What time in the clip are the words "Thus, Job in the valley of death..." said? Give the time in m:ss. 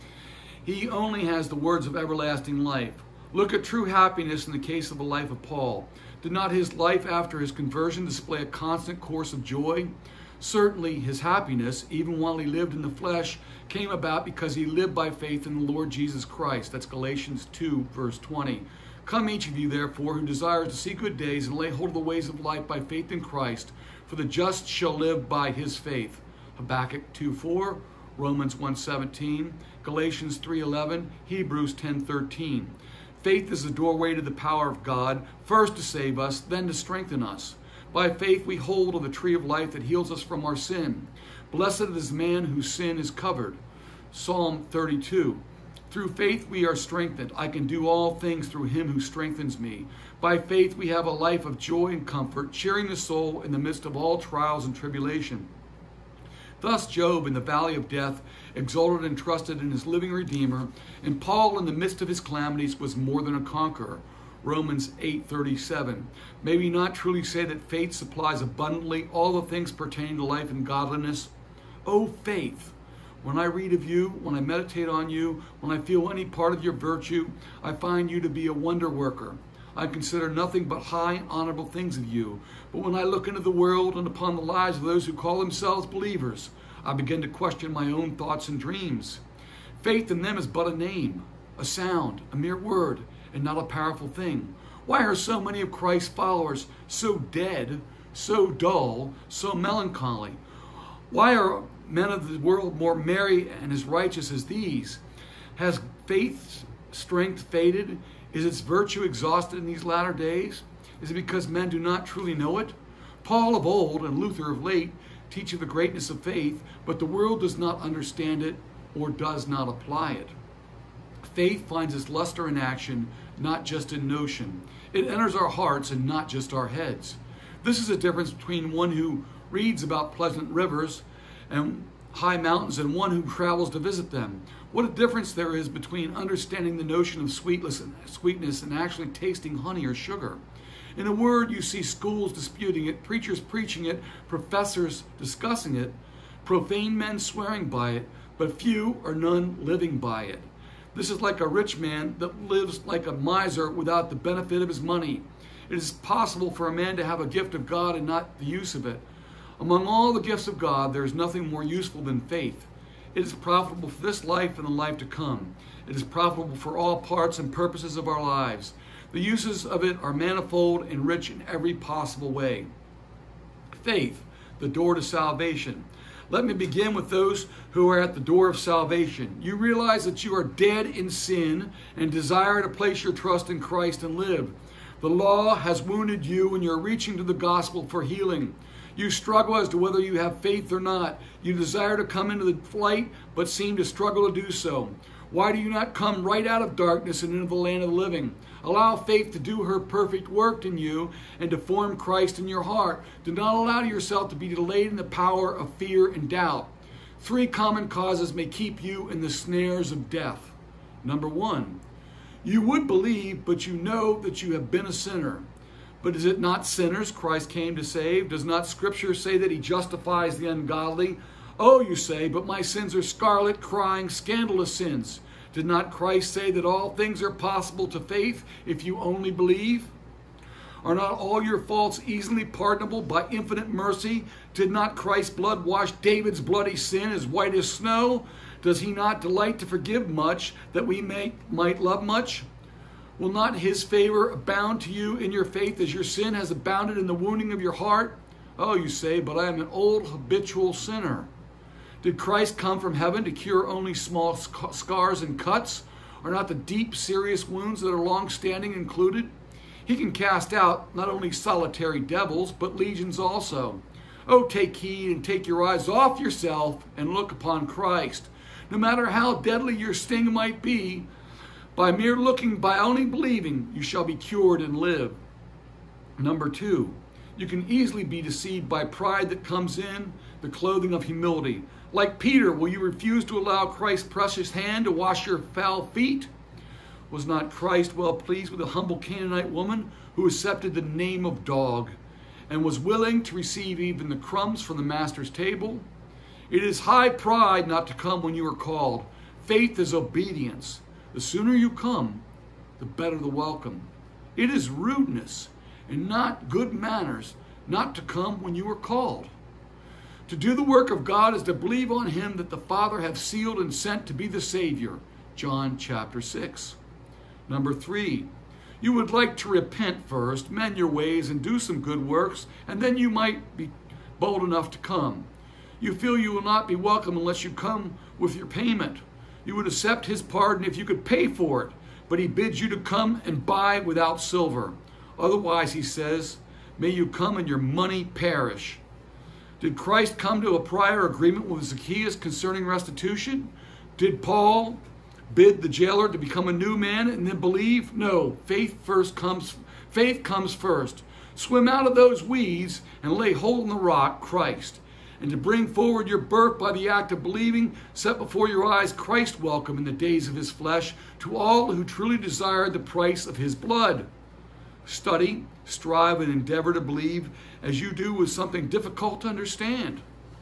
0:56.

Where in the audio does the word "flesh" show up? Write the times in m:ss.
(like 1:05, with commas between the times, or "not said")
0:12, 6:00.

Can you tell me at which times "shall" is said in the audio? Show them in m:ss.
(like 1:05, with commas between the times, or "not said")
0:24, 4:33.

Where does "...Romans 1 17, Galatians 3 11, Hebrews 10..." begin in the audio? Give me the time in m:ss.
0:28.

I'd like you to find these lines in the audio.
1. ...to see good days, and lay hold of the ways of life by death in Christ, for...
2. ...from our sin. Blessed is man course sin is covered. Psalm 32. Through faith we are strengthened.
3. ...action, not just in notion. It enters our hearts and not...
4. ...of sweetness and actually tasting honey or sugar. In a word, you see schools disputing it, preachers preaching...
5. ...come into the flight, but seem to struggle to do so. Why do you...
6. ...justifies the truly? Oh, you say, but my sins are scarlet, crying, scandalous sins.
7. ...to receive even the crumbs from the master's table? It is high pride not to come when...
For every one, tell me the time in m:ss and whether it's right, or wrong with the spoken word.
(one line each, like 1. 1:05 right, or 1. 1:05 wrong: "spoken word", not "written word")
1. 0:20 wrong: "faith", not "death"
2. 0:40 wrong: "whose", not "course"
3. 2:02 right
4. 2:17 right
5. 3:12 right
6. 3:39 wrong: "ungodly", not "truly"
7. 4:53 right.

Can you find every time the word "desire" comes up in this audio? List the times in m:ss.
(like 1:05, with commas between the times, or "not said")
0:20, 3:02, 3:11, 6:02.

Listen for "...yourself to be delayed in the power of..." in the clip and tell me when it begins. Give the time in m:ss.
3:23.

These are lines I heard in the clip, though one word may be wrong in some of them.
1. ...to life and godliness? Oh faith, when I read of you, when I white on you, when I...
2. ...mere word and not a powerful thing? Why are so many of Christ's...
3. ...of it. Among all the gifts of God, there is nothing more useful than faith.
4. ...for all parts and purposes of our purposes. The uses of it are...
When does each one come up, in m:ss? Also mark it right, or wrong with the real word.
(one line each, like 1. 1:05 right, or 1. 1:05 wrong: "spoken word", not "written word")
1. 1:10 wrong: "meditate", not "white"
2. 1:32 right
3. 2:38 right
4. 2:46 wrong: "lives", not "purposes".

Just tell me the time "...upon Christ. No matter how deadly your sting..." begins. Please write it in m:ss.
4:27.